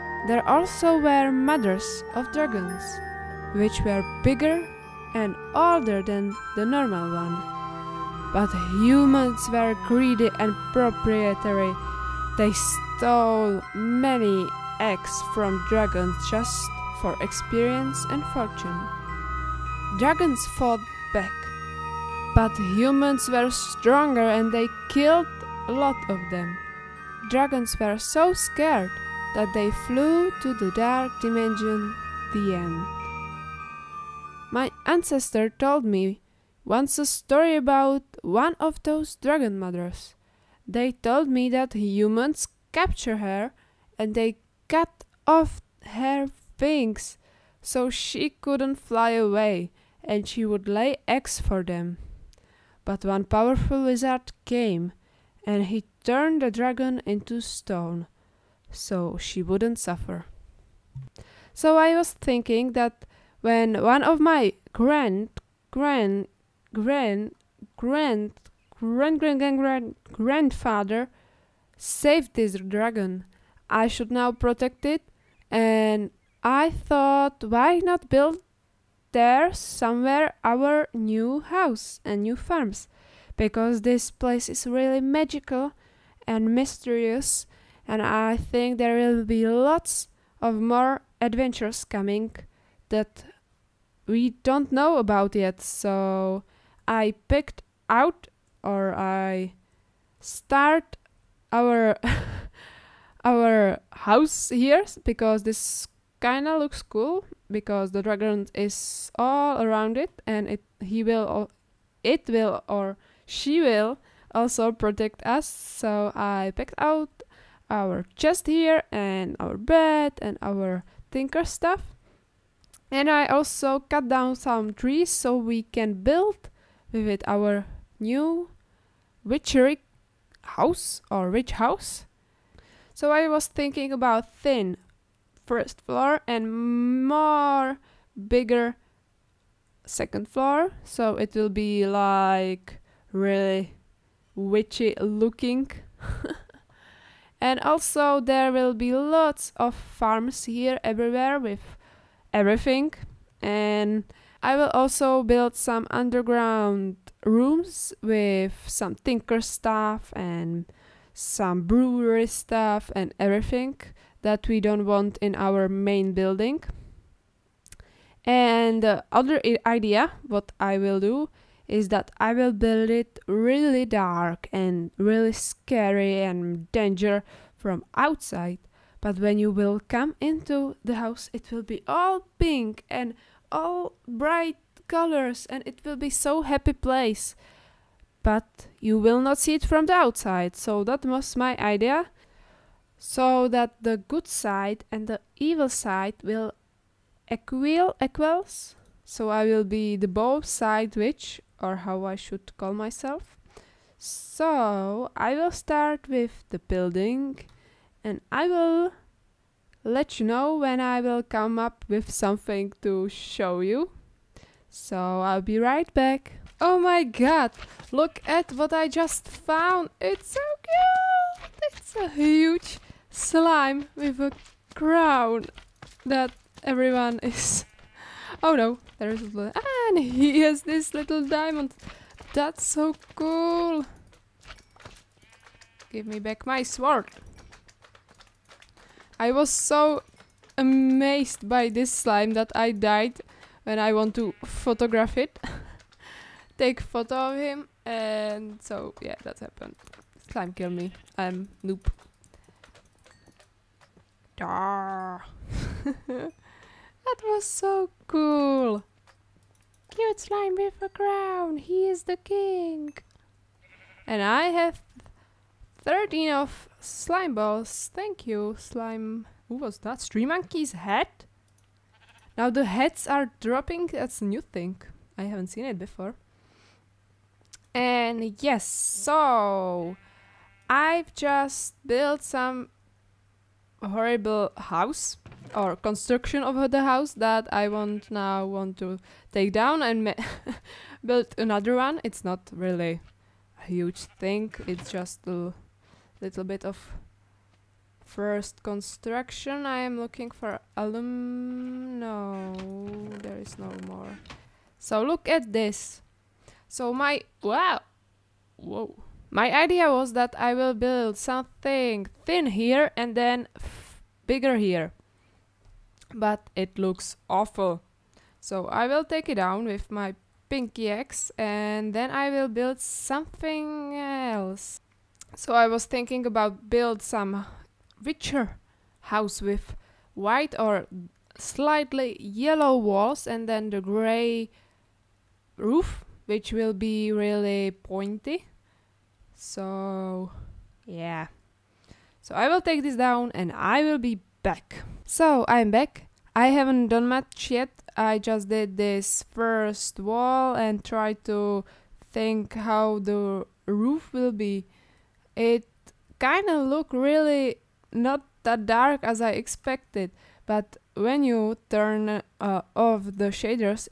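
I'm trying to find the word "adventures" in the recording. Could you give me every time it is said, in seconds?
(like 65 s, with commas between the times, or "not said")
91 s.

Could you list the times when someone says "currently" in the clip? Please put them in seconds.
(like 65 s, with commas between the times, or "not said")
not said.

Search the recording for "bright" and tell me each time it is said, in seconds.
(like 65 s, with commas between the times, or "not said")
184 s.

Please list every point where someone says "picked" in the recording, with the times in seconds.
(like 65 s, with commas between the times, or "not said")
97 s, 116 s.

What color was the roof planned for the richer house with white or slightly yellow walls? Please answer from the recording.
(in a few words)
Gray.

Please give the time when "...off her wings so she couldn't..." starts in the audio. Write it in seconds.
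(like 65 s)
45 s.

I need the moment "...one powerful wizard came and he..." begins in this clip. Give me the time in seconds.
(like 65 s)
53 s.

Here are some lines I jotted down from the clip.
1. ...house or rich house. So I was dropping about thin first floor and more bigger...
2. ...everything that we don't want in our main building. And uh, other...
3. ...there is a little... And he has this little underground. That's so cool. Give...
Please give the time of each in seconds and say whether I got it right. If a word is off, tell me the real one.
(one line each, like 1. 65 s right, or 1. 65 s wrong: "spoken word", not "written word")
1. 130 s wrong: "thinking", not "dropping"
2. 163 s right
3. 228 s wrong: "diamond", not "underground".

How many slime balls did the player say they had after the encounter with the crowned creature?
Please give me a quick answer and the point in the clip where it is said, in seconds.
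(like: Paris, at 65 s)
13, at 265 s.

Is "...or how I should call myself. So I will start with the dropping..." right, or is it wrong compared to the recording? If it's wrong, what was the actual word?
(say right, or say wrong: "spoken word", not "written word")
wrong: "building", not "dropping".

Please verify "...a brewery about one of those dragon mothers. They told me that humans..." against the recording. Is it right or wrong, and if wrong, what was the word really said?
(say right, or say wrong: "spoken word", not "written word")
wrong: "story", not "brewery".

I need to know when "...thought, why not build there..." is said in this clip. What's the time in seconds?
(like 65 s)
76 s.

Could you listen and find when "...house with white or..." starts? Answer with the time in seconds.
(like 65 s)
329 s.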